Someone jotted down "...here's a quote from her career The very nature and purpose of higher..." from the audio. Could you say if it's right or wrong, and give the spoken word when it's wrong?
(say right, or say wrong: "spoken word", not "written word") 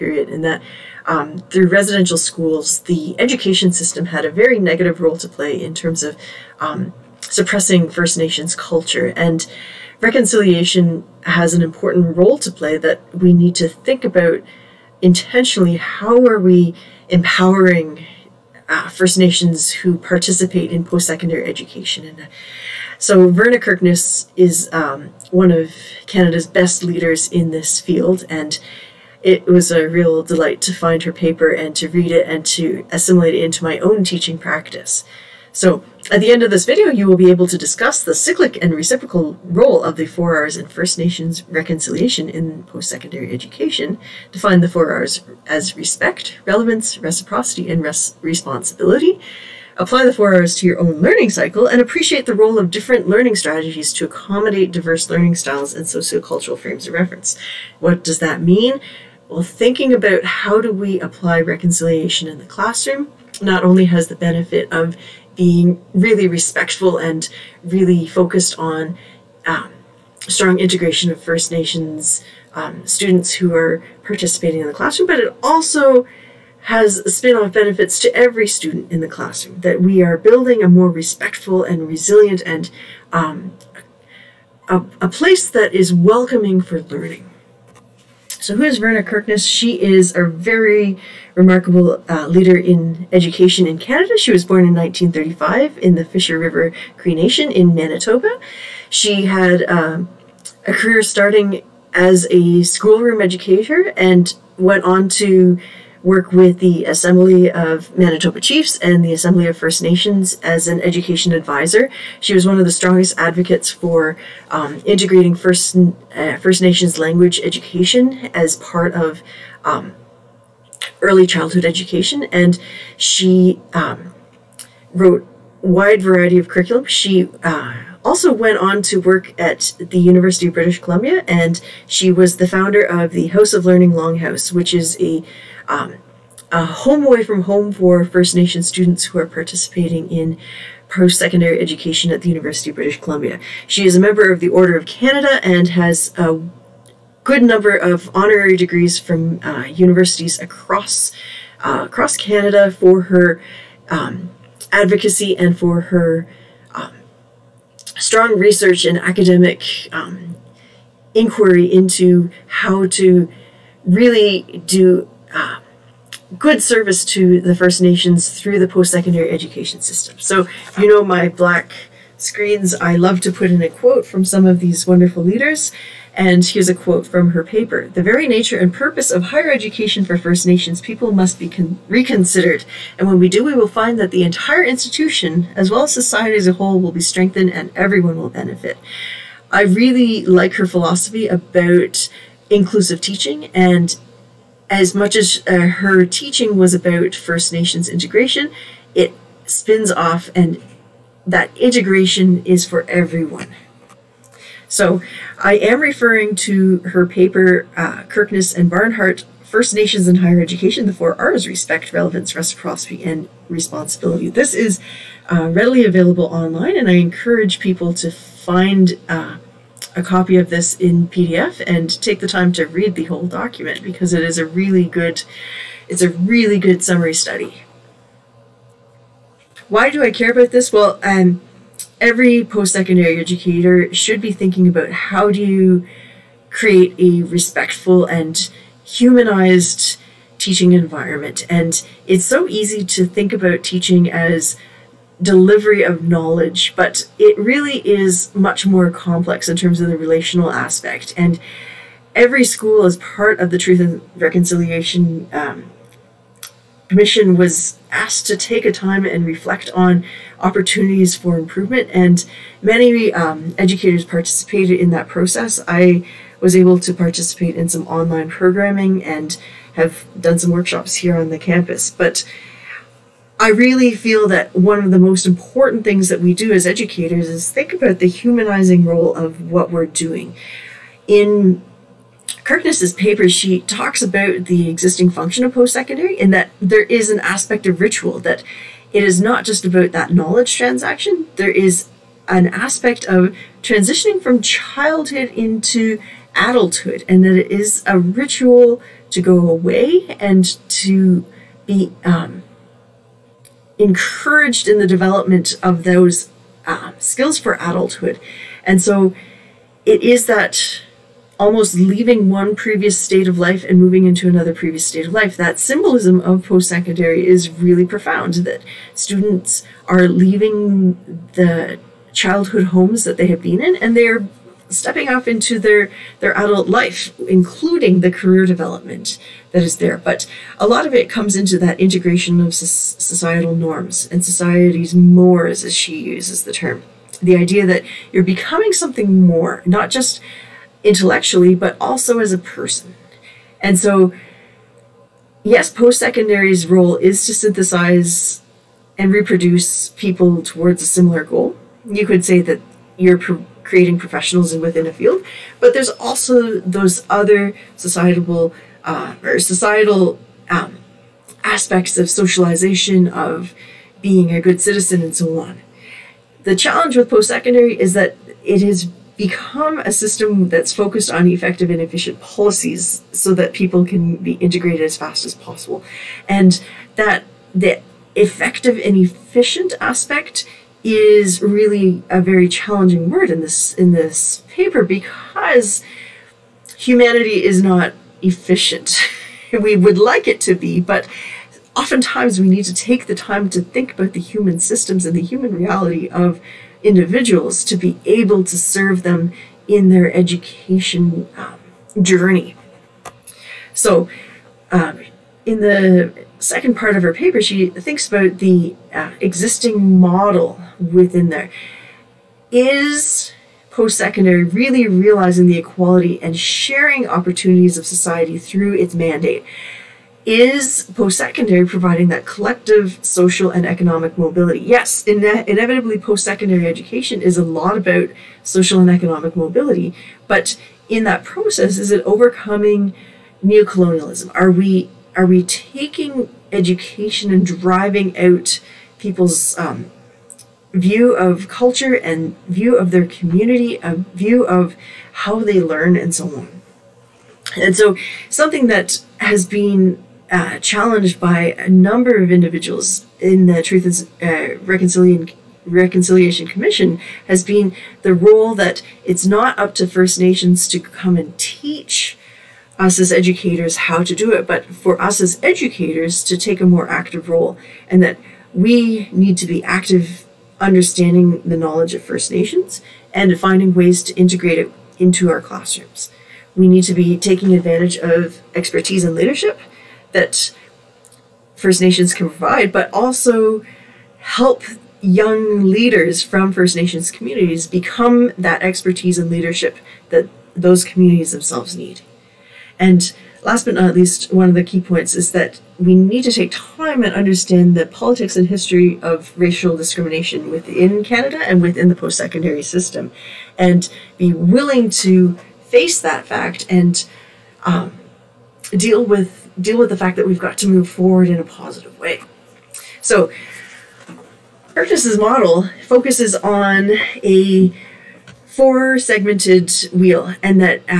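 wrong: "paper", not "career".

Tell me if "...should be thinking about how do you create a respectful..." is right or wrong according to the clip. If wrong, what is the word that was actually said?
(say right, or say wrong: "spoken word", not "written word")
right.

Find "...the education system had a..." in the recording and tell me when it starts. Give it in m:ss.
0:02.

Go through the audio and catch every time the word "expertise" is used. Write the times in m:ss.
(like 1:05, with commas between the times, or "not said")
7:58, 8:08.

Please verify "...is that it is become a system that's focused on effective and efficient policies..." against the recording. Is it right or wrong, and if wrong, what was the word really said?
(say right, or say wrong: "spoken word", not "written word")
right.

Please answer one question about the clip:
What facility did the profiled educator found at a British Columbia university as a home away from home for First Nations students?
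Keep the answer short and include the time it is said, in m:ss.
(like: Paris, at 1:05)
House of Learning Longhouse, at 2:13.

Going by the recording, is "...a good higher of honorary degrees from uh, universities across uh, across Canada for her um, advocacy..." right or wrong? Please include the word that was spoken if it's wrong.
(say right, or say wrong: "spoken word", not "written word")
wrong: "number", not "higher".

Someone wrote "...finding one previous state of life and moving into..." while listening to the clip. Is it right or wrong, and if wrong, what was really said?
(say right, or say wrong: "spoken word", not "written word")
wrong: "leaving", not "finding".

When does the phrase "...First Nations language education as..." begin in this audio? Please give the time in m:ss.
1:56.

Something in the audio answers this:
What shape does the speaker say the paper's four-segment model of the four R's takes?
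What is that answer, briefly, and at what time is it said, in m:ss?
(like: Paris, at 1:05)
wheel, at 8:39.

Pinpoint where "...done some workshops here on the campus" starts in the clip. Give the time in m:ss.
4:30.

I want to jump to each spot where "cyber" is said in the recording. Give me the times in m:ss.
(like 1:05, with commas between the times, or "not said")
not said.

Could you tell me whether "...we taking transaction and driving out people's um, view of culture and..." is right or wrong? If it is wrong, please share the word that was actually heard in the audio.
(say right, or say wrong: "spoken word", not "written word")
wrong: "education", not "transaction".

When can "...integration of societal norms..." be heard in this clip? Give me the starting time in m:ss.
5:31.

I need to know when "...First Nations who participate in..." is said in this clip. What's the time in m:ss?
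0:18.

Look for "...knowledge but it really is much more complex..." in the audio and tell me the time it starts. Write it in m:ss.
4:06.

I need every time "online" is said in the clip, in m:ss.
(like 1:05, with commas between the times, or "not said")
3:36, 4:27.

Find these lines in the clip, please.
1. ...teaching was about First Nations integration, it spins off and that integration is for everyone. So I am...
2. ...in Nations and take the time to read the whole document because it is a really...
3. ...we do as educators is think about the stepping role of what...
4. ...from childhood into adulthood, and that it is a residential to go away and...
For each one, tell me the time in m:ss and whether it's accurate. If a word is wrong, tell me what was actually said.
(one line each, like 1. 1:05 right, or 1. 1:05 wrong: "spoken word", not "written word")
1. 3:16 right
2. 3:40 wrong: "PDF", not "Nations"
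3. 4:36 wrong: "humanizing", not "stepping"
4. 4:54 wrong: "ritual", not "residential".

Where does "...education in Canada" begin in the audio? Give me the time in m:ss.
1:33.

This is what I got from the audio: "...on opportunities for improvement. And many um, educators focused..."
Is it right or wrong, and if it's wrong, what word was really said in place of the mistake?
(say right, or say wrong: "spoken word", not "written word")
wrong: "participated", not "focused".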